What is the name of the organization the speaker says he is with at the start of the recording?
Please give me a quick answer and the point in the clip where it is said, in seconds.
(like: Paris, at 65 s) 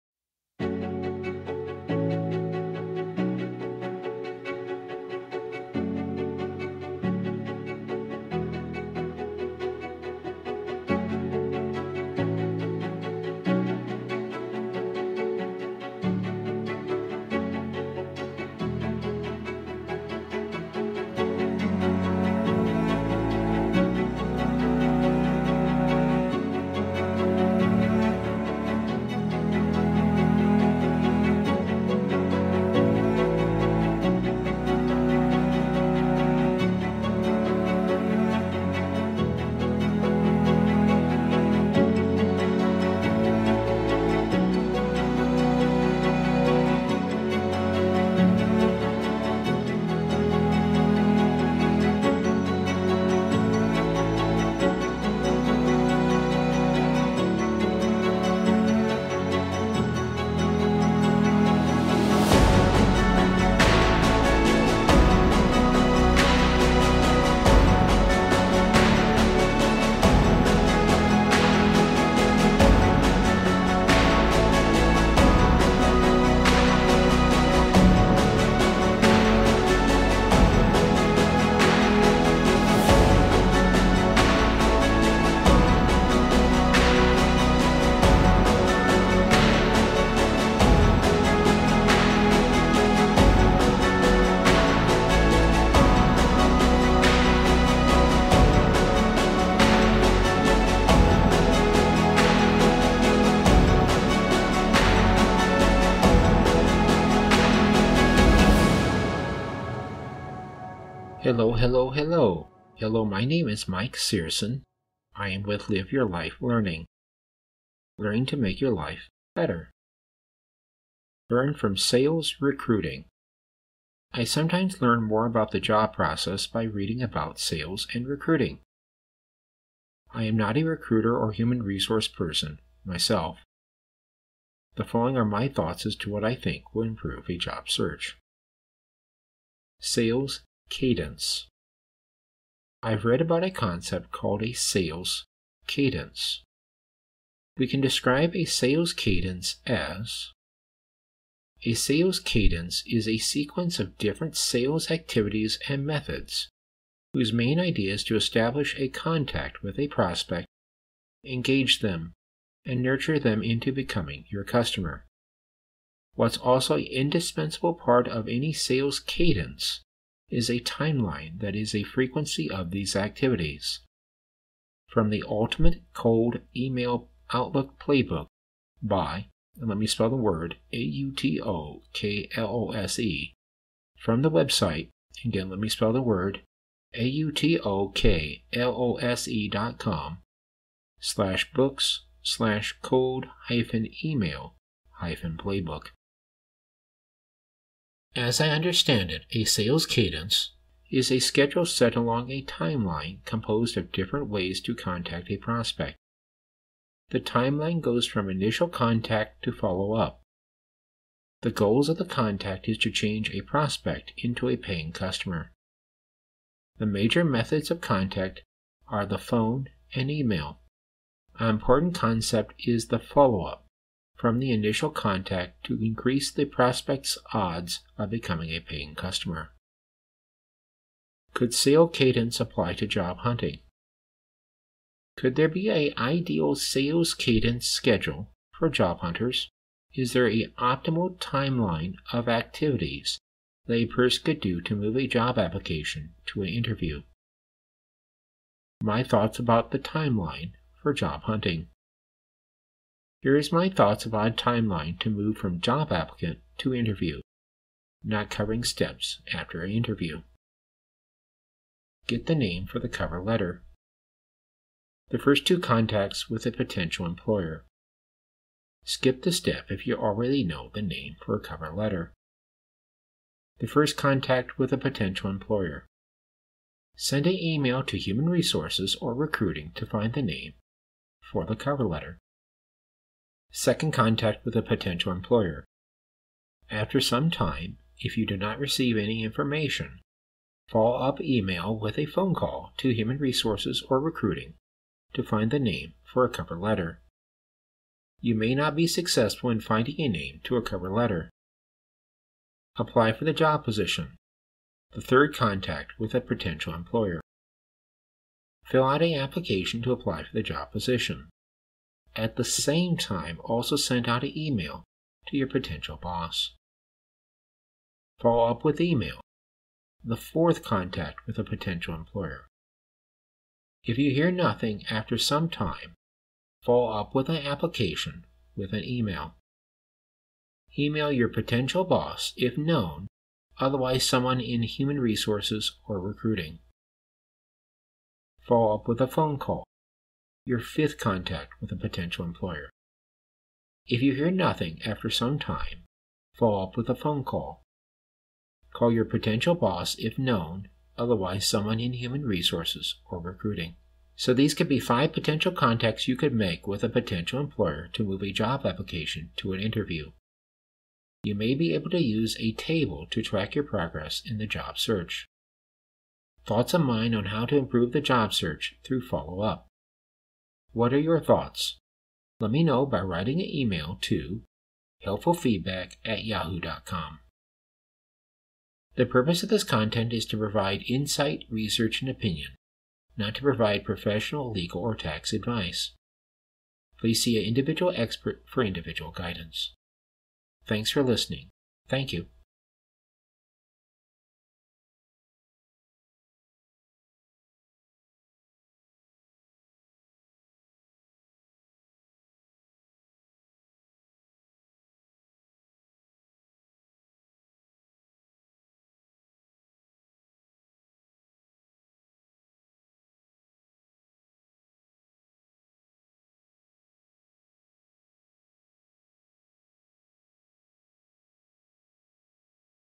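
Live Your Life Learning, at 115 s.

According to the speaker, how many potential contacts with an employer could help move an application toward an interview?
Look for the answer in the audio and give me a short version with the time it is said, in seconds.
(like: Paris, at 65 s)
5, at 354 s.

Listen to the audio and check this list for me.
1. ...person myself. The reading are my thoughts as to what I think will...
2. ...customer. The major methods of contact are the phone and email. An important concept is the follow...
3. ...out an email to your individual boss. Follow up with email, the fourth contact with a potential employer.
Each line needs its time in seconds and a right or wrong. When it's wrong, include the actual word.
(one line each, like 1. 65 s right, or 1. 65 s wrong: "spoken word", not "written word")
1. 132 s wrong: "following", not "reading"
2. 214 s right
3. 314 s wrong: "potential", not "individual".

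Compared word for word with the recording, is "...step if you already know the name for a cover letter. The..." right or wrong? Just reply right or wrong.
right.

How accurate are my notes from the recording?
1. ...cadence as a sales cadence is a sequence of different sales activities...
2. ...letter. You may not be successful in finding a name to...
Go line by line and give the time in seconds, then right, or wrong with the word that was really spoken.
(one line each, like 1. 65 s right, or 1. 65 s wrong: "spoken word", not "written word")
1. 148 s right
2. 296 s right.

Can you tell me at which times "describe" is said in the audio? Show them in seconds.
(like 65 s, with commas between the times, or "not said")
147 s.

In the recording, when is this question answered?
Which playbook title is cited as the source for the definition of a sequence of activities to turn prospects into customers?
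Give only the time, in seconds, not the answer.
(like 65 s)
175 s.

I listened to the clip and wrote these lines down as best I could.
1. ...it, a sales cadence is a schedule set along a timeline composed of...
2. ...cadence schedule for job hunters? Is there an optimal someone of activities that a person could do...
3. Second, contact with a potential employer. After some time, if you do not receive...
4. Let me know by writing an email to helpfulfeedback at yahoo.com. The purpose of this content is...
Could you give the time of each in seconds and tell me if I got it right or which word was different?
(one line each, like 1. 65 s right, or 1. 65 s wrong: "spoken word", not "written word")
1. 199 s right
2. 237 s wrong: "timeline", not "someone"
3. 283 s right
4. 372 s right.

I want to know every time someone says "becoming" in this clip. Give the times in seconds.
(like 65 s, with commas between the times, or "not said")
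163 s, 228 s.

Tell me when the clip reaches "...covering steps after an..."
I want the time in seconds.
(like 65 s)
258 s.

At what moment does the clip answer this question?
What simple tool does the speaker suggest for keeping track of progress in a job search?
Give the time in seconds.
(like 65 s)
362 s.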